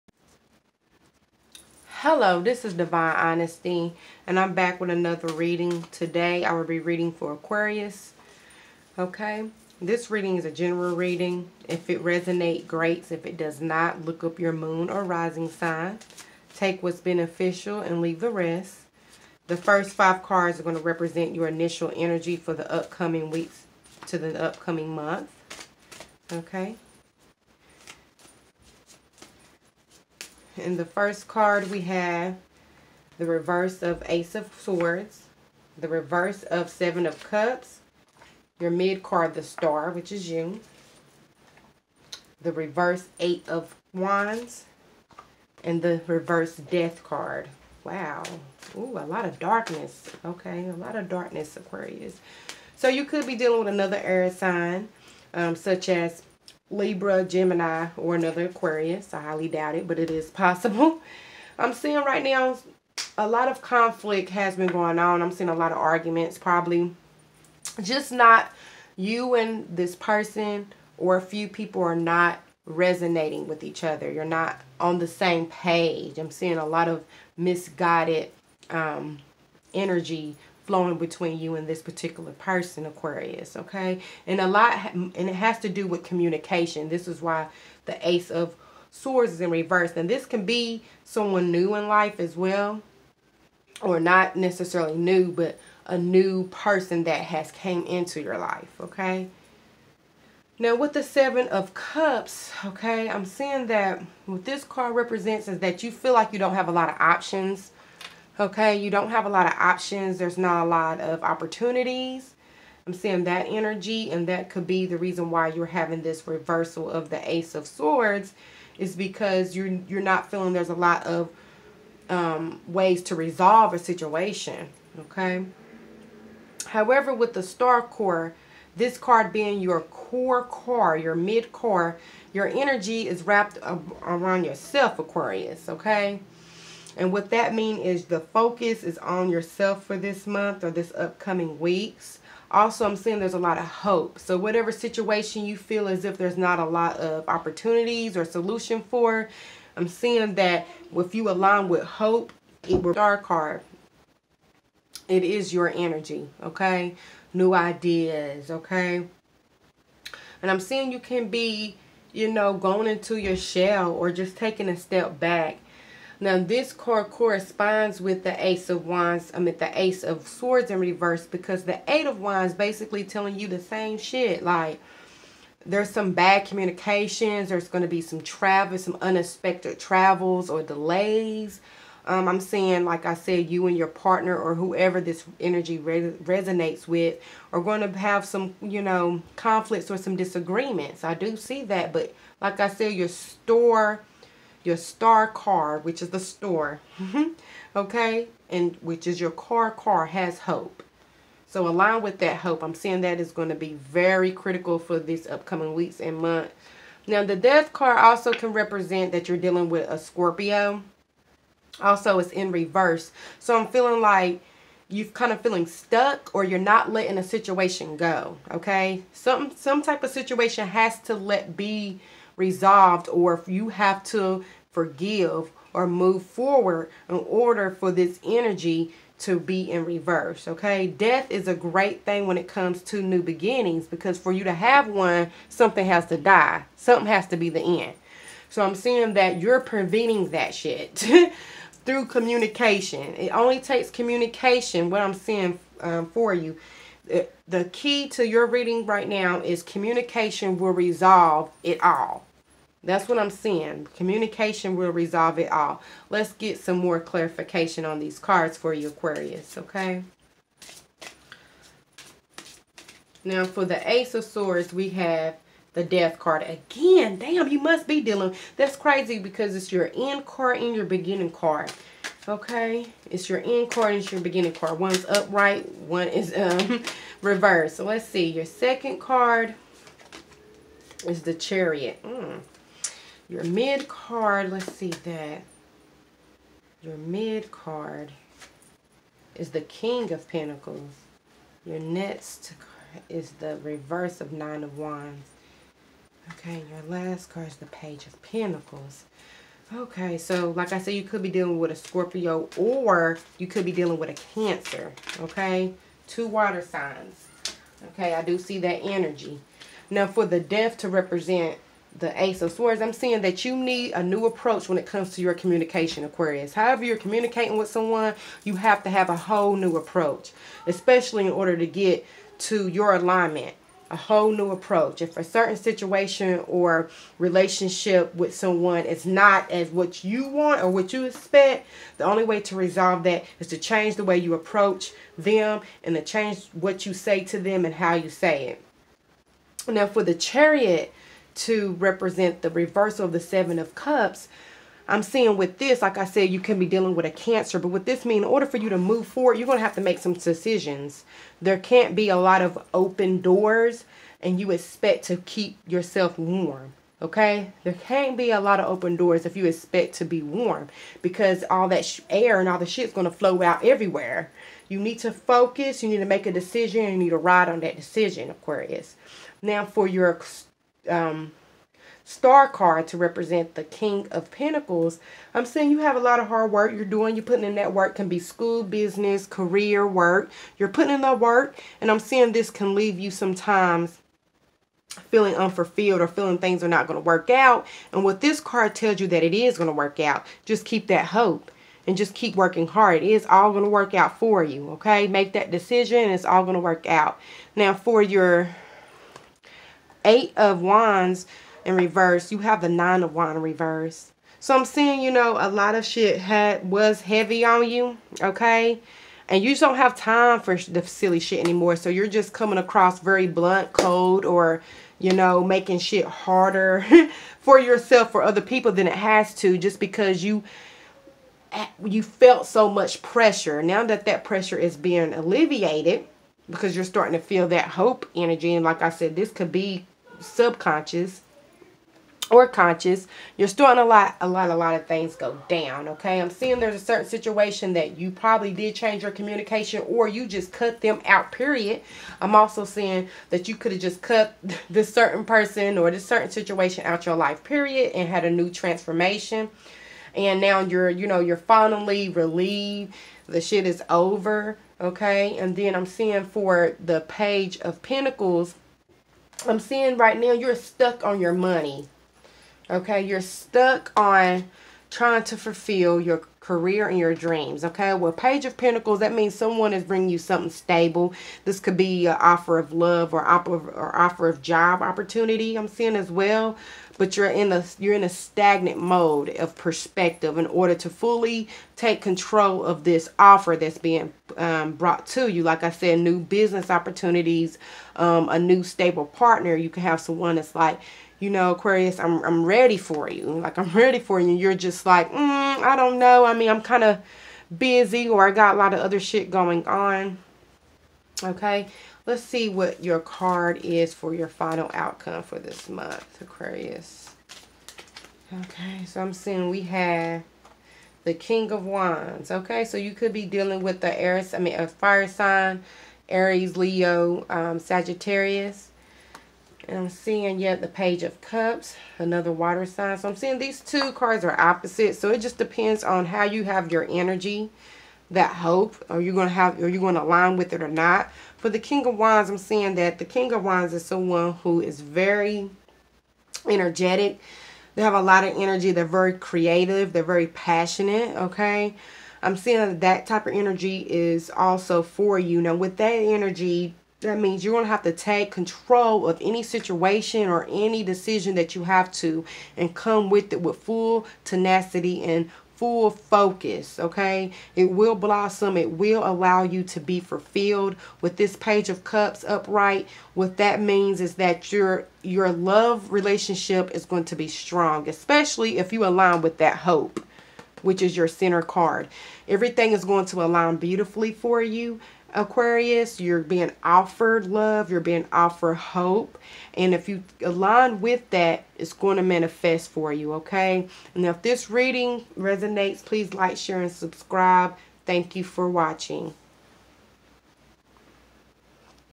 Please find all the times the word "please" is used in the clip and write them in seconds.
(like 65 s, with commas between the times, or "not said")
585 s.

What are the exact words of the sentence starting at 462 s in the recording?
Okay, you're stuck on trying to fulfill your career and your dreams.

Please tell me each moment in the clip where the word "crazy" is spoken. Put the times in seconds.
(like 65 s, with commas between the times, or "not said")
268 s.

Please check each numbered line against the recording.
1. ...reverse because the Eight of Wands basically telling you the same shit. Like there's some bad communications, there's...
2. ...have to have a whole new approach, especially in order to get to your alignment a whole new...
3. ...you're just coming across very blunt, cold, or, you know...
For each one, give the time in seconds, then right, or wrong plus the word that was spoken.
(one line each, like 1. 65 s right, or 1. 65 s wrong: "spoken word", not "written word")
1. 170 s right
2. 318 s right
3. 411 s right.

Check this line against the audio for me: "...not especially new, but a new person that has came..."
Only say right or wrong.
wrong.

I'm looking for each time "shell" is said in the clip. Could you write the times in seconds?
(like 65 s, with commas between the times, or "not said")
163 s.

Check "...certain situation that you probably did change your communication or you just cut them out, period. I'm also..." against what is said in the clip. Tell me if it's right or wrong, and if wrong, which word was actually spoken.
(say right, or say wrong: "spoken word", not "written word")
right.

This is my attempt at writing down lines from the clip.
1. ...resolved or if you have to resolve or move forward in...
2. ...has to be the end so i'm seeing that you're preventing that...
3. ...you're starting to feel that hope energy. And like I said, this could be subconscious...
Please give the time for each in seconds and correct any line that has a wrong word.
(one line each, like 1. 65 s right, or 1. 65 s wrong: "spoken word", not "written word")
1. 222 s wrong: "forgive", not "resolve"
2. 237 s right
3. 426 s right.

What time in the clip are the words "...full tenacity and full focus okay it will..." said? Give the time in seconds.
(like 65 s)
553 s.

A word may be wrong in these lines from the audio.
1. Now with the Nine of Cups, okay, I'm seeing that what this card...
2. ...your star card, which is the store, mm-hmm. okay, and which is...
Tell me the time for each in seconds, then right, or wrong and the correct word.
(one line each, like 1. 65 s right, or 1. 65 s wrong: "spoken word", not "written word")
1. 100 s wrong: "Seven", not "Nine"
2. 194 s right.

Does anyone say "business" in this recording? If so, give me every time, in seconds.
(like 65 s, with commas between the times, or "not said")
378 s, 486 s.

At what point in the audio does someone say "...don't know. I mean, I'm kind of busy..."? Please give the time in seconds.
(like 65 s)
495 s.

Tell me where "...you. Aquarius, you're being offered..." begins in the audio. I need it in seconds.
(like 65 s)
574 s.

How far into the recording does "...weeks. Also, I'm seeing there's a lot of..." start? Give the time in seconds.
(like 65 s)
141 s.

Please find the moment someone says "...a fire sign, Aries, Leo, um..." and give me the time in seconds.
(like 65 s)
514 s.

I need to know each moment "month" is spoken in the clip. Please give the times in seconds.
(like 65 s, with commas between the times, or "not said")
24 s, 140 s, 206 s, 505 s.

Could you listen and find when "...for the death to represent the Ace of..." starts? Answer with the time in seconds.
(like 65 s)
310 s.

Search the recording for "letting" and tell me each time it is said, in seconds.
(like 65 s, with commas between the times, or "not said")
216 s.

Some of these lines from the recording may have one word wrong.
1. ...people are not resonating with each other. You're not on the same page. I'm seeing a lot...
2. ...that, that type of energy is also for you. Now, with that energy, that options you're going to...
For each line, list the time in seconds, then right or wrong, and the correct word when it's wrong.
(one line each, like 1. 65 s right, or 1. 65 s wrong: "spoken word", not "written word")
1. 71 s right
2. 542 s wrong: "means", not "options".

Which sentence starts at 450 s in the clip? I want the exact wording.
And now you're, you know, you're finally relieved.